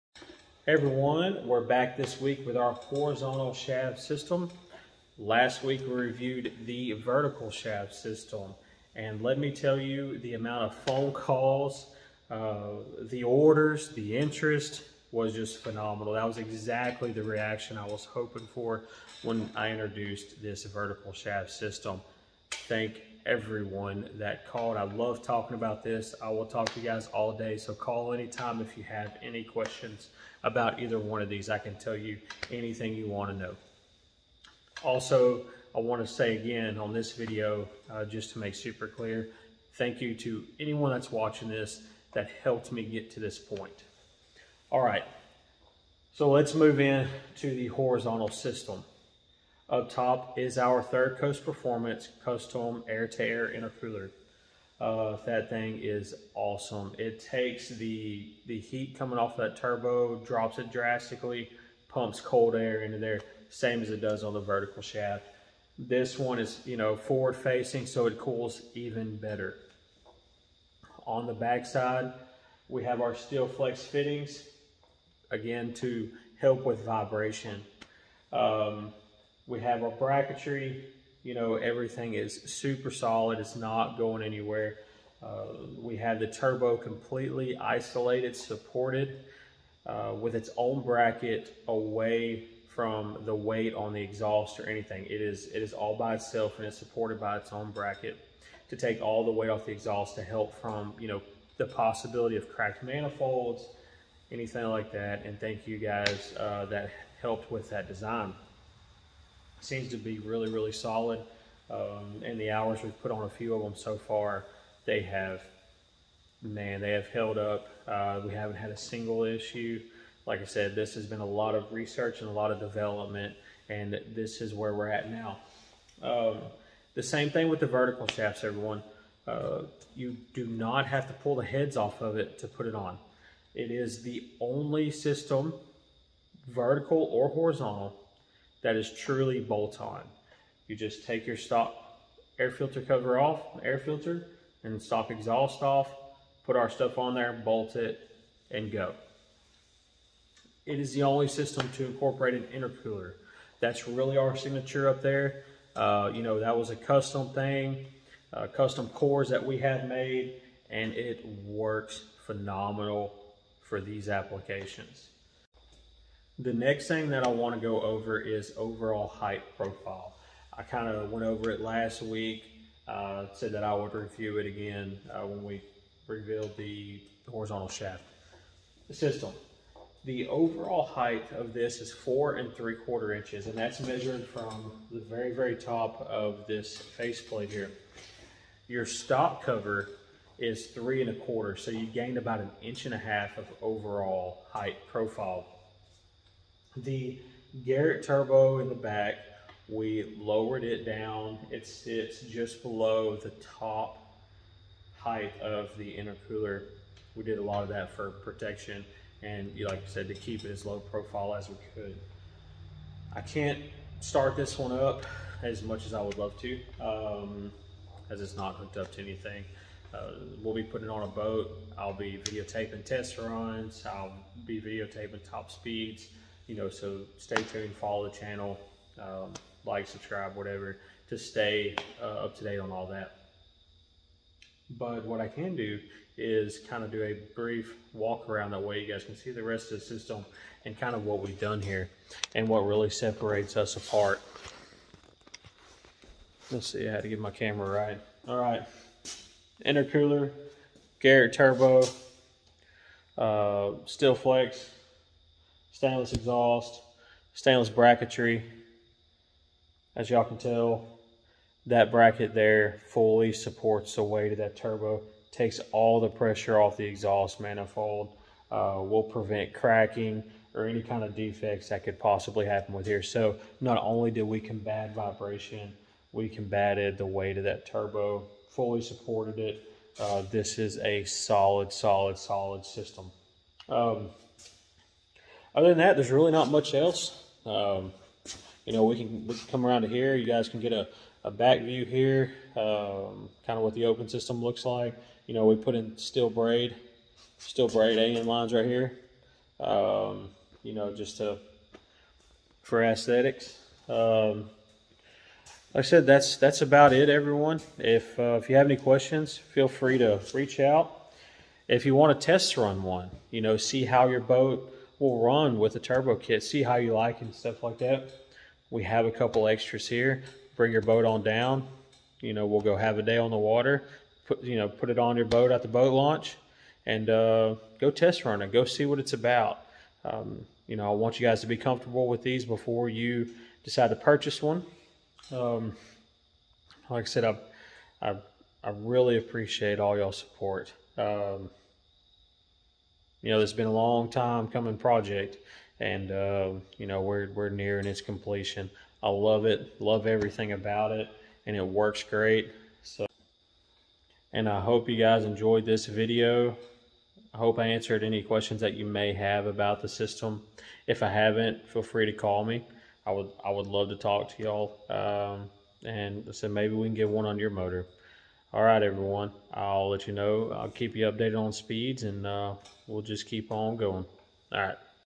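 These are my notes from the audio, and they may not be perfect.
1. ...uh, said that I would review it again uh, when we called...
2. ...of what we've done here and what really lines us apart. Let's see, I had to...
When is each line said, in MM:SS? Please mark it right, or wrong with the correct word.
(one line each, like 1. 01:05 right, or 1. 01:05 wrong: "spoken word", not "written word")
1. 02:52 wrong: "revealed", not "called"
2. 04:00 wrong: "separates", not "lines".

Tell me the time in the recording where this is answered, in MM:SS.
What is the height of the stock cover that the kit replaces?
03:10.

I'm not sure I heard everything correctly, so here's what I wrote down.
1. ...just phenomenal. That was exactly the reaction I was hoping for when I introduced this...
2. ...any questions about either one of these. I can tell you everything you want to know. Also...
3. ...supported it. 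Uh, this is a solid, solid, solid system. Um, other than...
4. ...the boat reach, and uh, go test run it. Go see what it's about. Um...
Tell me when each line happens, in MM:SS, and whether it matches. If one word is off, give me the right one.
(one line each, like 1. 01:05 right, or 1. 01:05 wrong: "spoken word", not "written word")
1. 00:15 right
2. 00:29 wrong: "anything", not "everything"
3. 04:38 right
4. 05:25 wrong: "launch", not "reach".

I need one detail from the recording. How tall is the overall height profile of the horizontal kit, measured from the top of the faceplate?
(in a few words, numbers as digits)
4 3/4 inches.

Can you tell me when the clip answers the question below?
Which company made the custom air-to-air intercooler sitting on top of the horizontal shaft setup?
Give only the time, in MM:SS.
00:50.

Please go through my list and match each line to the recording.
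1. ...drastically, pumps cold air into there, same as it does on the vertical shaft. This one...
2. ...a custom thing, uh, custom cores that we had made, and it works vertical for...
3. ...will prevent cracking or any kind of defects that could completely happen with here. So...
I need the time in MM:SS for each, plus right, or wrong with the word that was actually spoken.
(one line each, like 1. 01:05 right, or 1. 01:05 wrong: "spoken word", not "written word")
1. 01:00 right
2. 02:36 wrong: "phenomenal", not "vertical"
3. 04:28 wrong: "possibly", not "completely".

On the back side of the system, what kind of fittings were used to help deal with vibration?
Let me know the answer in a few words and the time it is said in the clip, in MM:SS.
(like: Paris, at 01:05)
steel flex fittings, at 01:13.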